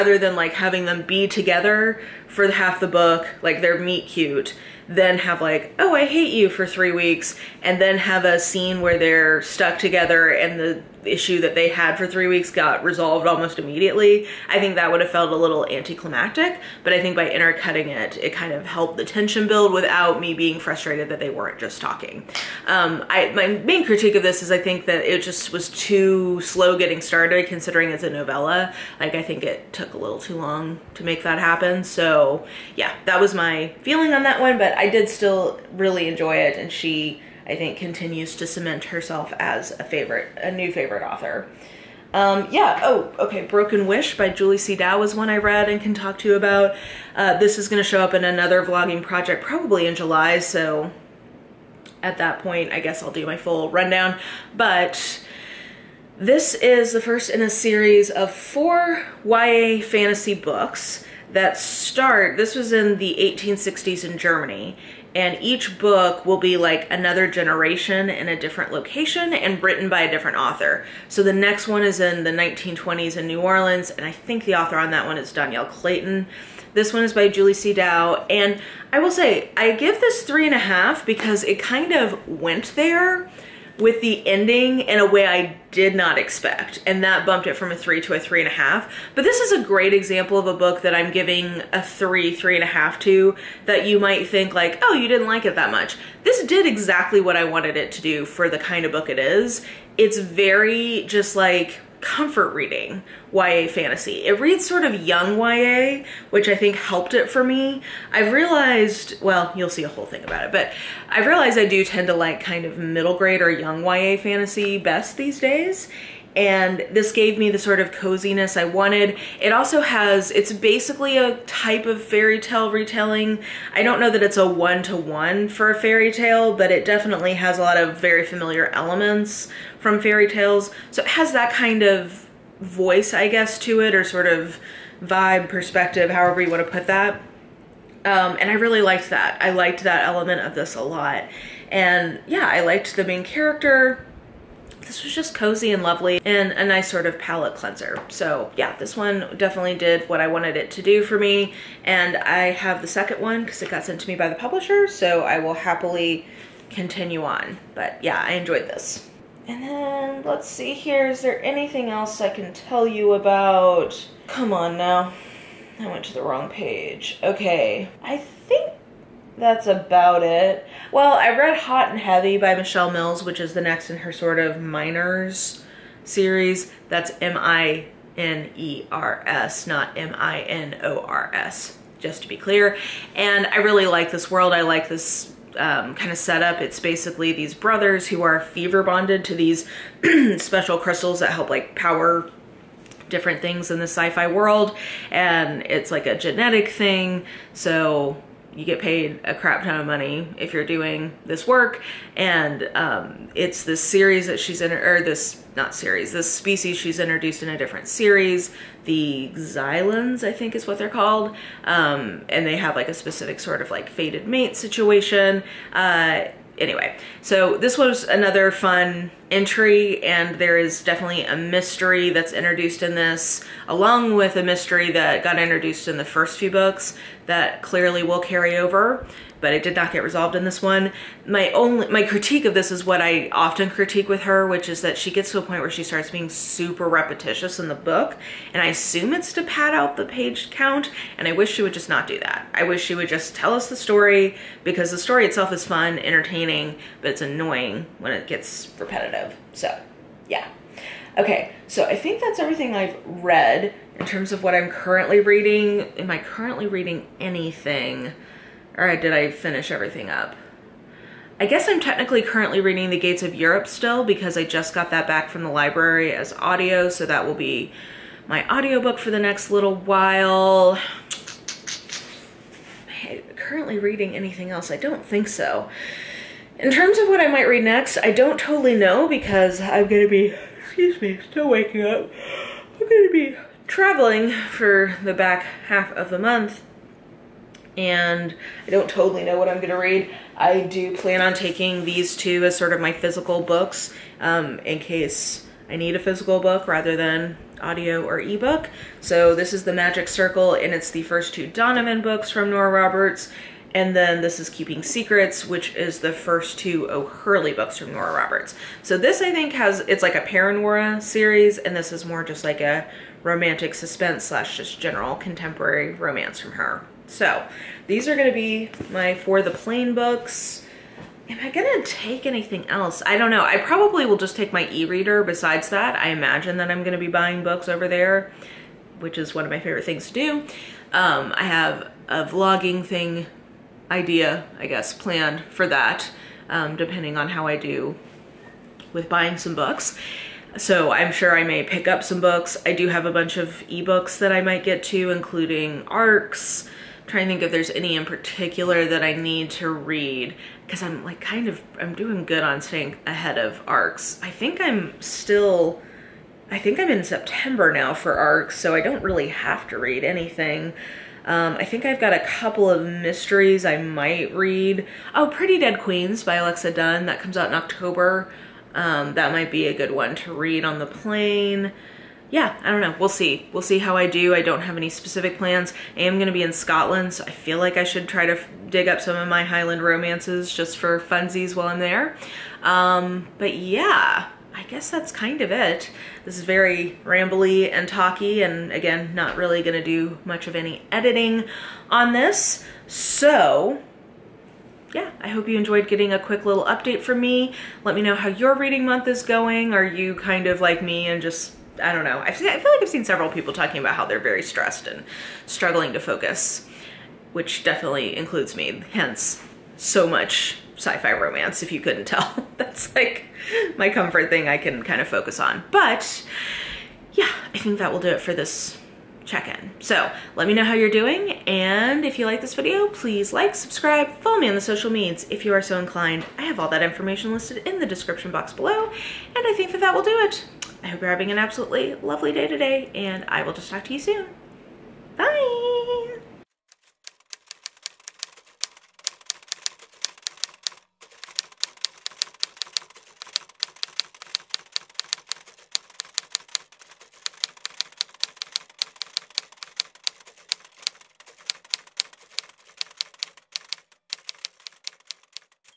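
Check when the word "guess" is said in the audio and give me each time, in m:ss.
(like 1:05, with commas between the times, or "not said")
0:52, 2:13, 4:21, 5:34, 6:24.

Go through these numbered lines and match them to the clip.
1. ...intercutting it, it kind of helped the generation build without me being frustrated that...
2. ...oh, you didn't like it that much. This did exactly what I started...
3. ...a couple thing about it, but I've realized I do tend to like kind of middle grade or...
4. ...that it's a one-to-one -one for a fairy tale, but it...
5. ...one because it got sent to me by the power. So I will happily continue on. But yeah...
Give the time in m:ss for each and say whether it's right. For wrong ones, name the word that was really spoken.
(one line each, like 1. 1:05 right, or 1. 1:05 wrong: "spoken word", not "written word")
1. 0:17 wrong: "tension", not "generation"
2. 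1:34 wrong: "wanted", not "started"
3. 1:49 wrong: "whole", not "couple"
4. 2:04 right
5. 2:33 wrong: "publisher", not "power".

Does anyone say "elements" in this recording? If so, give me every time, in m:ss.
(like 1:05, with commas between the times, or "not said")
2:08, 2:20.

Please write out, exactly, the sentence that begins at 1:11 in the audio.
So the next one is in the 1920s in New Orleans, and I think the author on that one is Dhonielle Clayton.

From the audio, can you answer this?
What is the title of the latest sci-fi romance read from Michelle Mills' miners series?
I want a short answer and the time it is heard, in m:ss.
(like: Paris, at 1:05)
Hot and Heavy, at 2:51.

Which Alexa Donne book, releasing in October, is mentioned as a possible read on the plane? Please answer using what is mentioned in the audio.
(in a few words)
Pretty Dead Queens.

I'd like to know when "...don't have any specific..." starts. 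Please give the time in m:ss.
6:14.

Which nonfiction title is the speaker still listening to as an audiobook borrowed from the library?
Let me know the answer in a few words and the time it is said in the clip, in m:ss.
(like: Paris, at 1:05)
The Gates of Europe, at 4:22.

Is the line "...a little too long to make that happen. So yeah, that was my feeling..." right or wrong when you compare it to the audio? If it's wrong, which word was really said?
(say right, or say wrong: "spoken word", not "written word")
right.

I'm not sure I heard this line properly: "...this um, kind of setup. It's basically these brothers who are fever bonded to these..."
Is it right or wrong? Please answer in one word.
right.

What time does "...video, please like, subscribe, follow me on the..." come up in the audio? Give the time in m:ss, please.
7:02.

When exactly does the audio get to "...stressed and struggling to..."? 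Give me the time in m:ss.
6:44.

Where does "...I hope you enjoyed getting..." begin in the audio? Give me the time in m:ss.
6:35.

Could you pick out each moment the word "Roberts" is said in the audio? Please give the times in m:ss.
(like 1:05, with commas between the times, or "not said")
5:02, 5:08.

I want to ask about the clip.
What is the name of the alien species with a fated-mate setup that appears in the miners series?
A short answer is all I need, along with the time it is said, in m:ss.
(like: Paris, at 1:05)
Xylans, at 3:28.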